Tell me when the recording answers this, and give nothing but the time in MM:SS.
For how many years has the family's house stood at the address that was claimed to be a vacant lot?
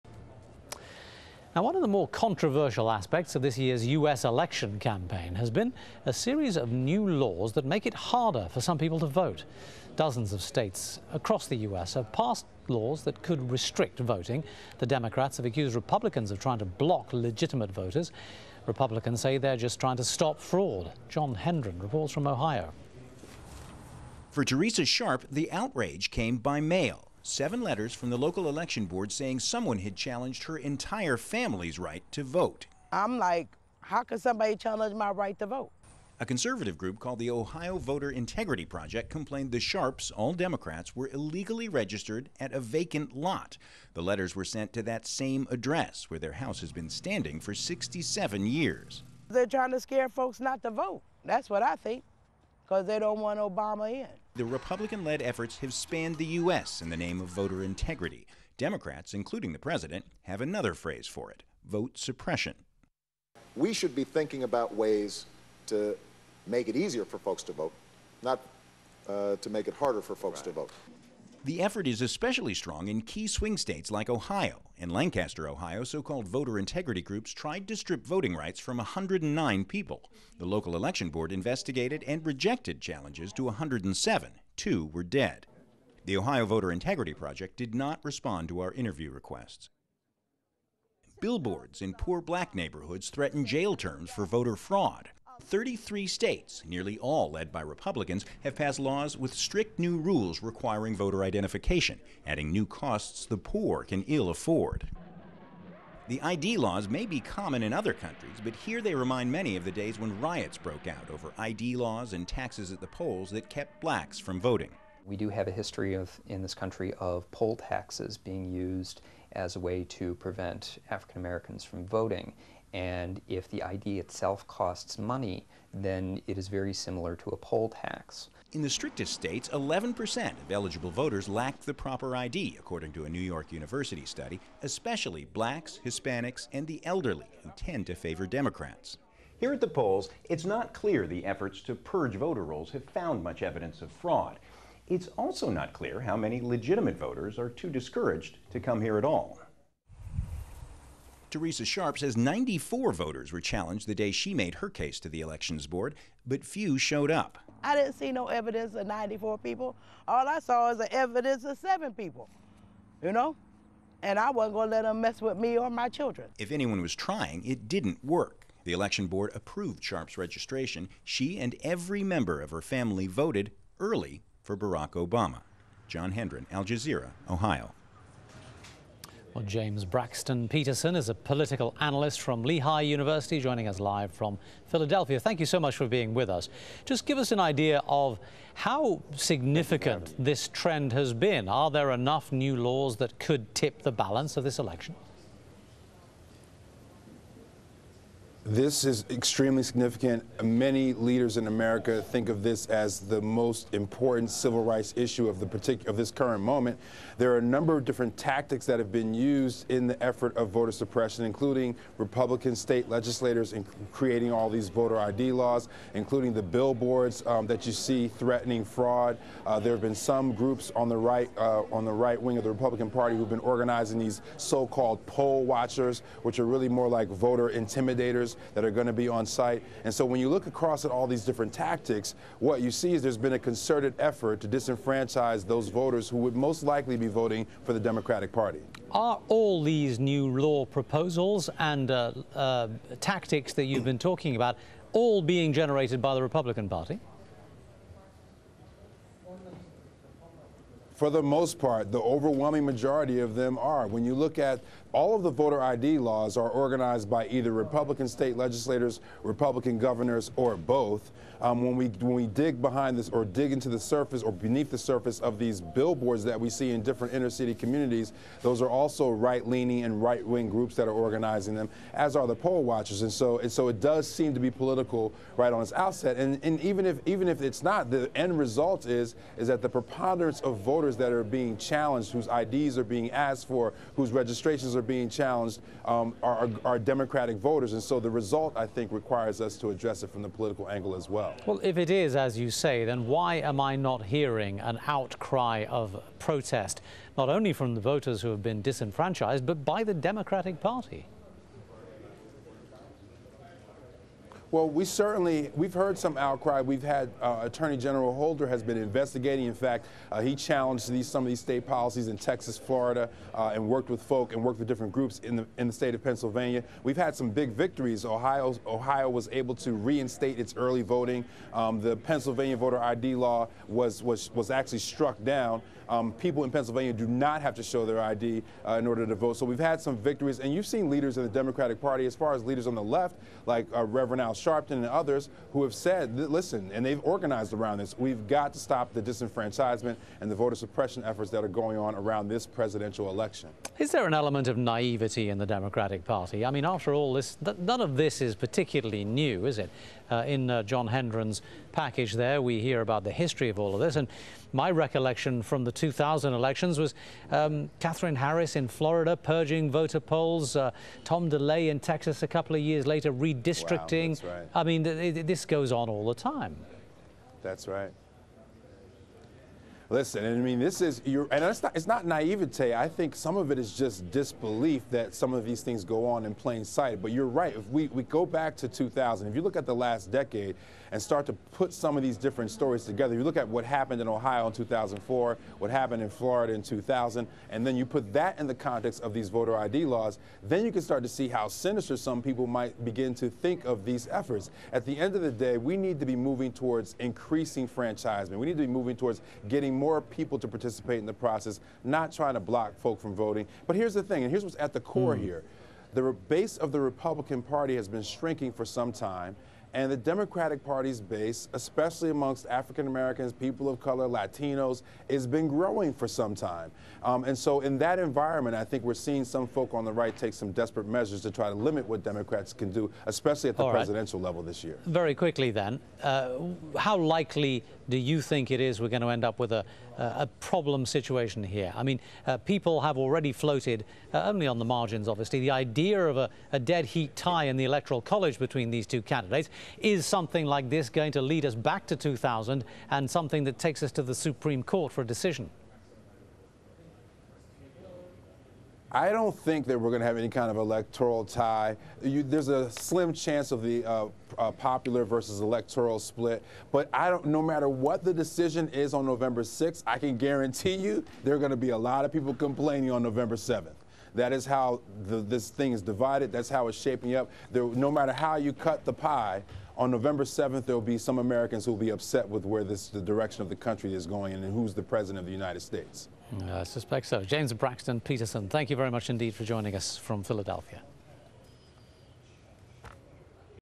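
00:47.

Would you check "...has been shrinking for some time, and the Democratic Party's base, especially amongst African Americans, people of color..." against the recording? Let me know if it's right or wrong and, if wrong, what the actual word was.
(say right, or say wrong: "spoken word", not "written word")
right.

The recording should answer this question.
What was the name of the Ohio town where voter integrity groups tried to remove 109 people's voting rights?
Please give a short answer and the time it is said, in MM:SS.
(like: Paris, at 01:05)
Lancaster, at 01:14.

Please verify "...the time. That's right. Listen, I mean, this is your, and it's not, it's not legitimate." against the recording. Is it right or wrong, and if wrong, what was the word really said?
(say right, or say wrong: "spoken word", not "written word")
wrong: "naivete", not "legitimate".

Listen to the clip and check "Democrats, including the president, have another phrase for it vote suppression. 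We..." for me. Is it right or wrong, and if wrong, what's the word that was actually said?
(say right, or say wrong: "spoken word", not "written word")
right.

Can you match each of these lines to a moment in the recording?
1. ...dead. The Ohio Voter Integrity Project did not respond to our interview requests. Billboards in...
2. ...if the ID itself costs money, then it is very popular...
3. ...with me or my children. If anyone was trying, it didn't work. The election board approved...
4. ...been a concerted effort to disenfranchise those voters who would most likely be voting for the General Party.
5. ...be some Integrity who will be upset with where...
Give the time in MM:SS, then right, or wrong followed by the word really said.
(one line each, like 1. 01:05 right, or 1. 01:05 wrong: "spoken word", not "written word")
1. 01:25 right
2. 02:03 wrong: "similar", not "popular"
3. 02:45 right
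4. 03:53 wrong: "Democratic", not "General"
5. 07:50 wrong: "Americans", not "Integrity".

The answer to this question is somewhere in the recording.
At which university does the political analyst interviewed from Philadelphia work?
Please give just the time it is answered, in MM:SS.
03:02.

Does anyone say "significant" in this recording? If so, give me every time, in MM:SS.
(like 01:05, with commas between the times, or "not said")
03:09, 03:19.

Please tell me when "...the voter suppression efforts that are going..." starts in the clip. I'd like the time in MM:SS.
05:40.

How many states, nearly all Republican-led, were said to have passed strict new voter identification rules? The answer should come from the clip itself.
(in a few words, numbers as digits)
33.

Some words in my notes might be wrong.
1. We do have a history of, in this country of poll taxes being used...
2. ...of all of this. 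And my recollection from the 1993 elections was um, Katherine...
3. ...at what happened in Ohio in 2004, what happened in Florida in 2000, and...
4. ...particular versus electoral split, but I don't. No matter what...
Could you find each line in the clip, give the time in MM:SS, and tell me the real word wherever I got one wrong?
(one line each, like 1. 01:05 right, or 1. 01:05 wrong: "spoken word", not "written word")
1. 01:55 right
2. 05:53 wrong: "2000", not "1993"
3. 06:23 right
4. 07:34 wrong: "popular", not "particular".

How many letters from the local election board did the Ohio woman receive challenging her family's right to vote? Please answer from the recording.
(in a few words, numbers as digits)
7.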